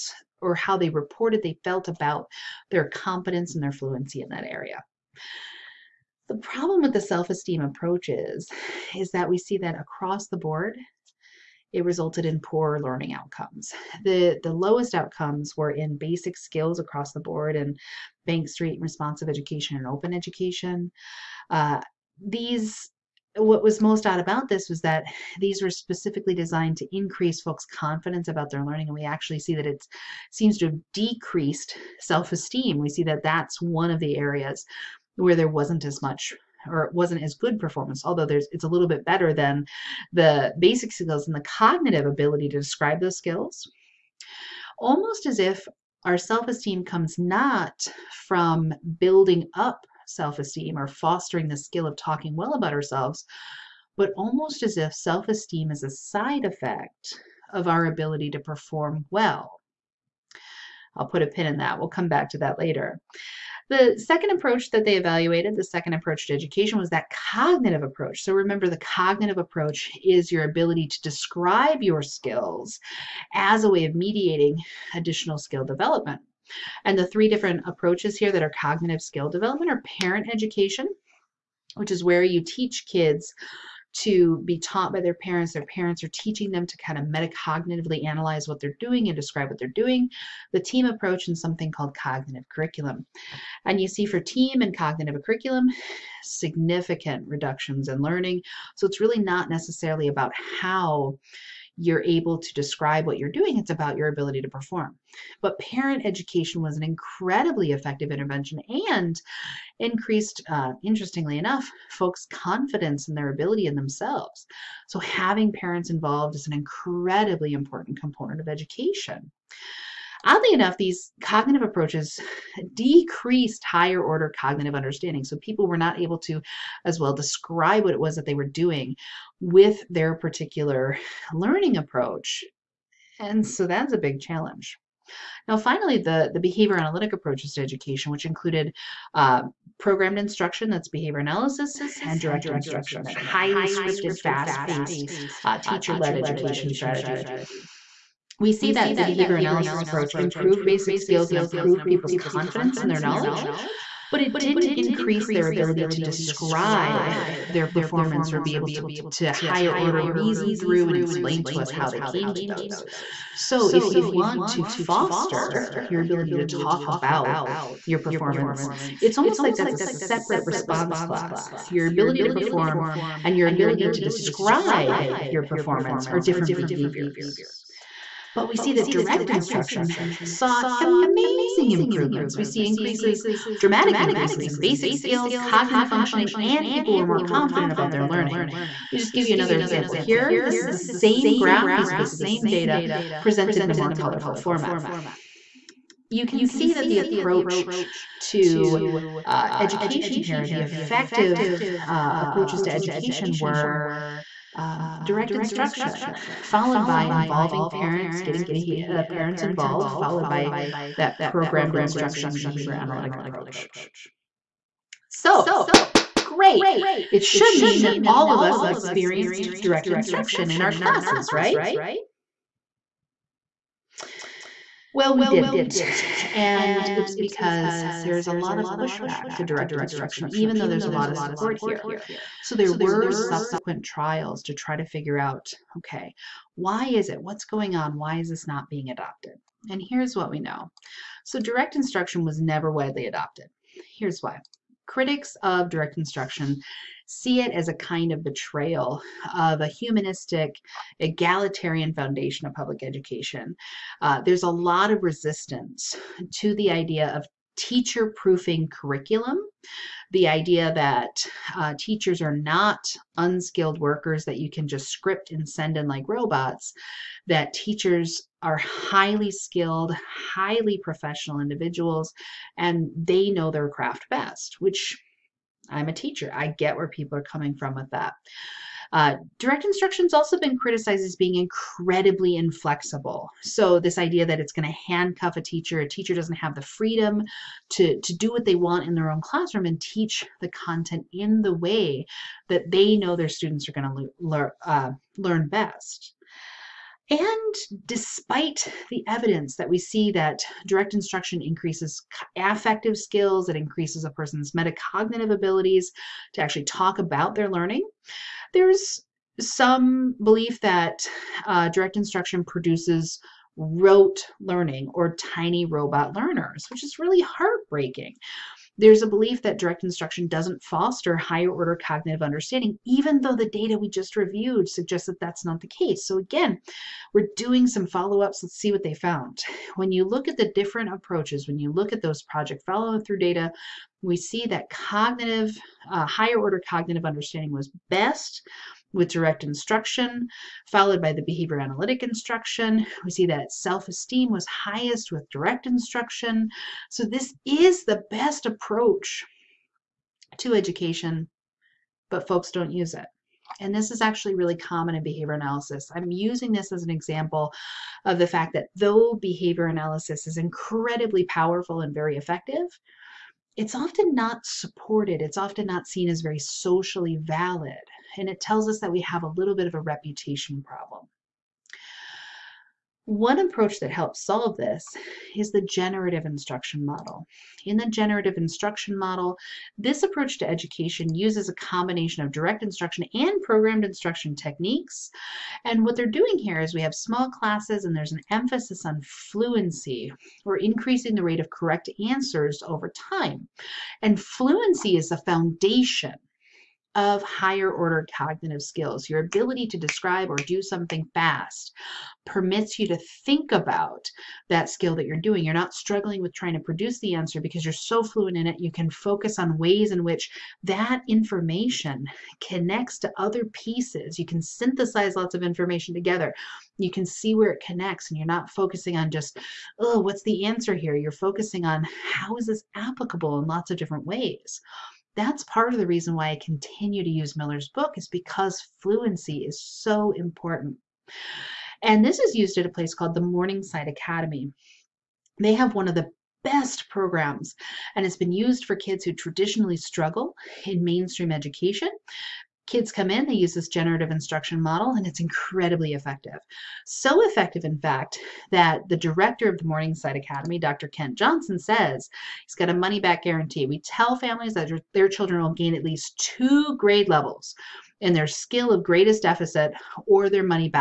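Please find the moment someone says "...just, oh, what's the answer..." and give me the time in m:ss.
6:59.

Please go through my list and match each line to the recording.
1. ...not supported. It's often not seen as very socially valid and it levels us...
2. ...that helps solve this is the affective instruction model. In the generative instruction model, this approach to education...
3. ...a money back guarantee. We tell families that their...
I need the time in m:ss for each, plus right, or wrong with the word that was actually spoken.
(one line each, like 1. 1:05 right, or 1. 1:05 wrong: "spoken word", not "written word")
1. 6:04 wrong: "tells", not "levels"
2. 6:13 wrong: "generative", not "affective"
3. 7:32 right.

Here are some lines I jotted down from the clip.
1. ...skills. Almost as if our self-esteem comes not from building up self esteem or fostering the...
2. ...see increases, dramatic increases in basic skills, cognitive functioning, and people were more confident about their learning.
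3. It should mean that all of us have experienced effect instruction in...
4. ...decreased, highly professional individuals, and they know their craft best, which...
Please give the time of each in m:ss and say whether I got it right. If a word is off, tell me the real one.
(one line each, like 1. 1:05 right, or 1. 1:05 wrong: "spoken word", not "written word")
1. 0:43 right
2. 3:02 right
3. 3:37 wrong: "direct", not "effect"
4. 4:29 wrong: "skilled", not "decreased".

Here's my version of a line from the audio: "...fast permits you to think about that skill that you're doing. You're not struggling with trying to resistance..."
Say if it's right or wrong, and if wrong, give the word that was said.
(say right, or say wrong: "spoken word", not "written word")
wrong: "produce", not "resistance".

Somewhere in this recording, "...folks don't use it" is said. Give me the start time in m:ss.
5:52.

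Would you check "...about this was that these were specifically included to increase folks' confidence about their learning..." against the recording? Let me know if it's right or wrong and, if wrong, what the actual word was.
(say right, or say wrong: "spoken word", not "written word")
wrong: "designed", not "included".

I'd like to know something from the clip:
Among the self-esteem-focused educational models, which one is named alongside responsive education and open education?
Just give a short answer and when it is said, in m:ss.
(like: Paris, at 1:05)
Bank Street, at 0:18.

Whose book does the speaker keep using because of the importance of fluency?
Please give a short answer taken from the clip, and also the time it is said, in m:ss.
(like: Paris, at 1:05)
Miller, at 7:07.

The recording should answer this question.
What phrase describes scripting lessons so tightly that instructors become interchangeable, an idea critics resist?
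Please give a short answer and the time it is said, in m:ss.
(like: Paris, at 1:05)
Teacher proofing, at 4:17.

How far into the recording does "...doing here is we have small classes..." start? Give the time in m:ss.
6:26.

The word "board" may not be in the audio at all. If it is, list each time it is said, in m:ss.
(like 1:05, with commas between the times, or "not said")
0:10, 0:17.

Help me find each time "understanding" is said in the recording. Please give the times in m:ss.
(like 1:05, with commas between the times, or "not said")
2:04, 5:22, 5:37.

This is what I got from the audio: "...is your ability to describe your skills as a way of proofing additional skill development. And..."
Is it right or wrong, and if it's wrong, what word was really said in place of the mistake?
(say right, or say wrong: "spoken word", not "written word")
wrong: "mediating", not "proofing".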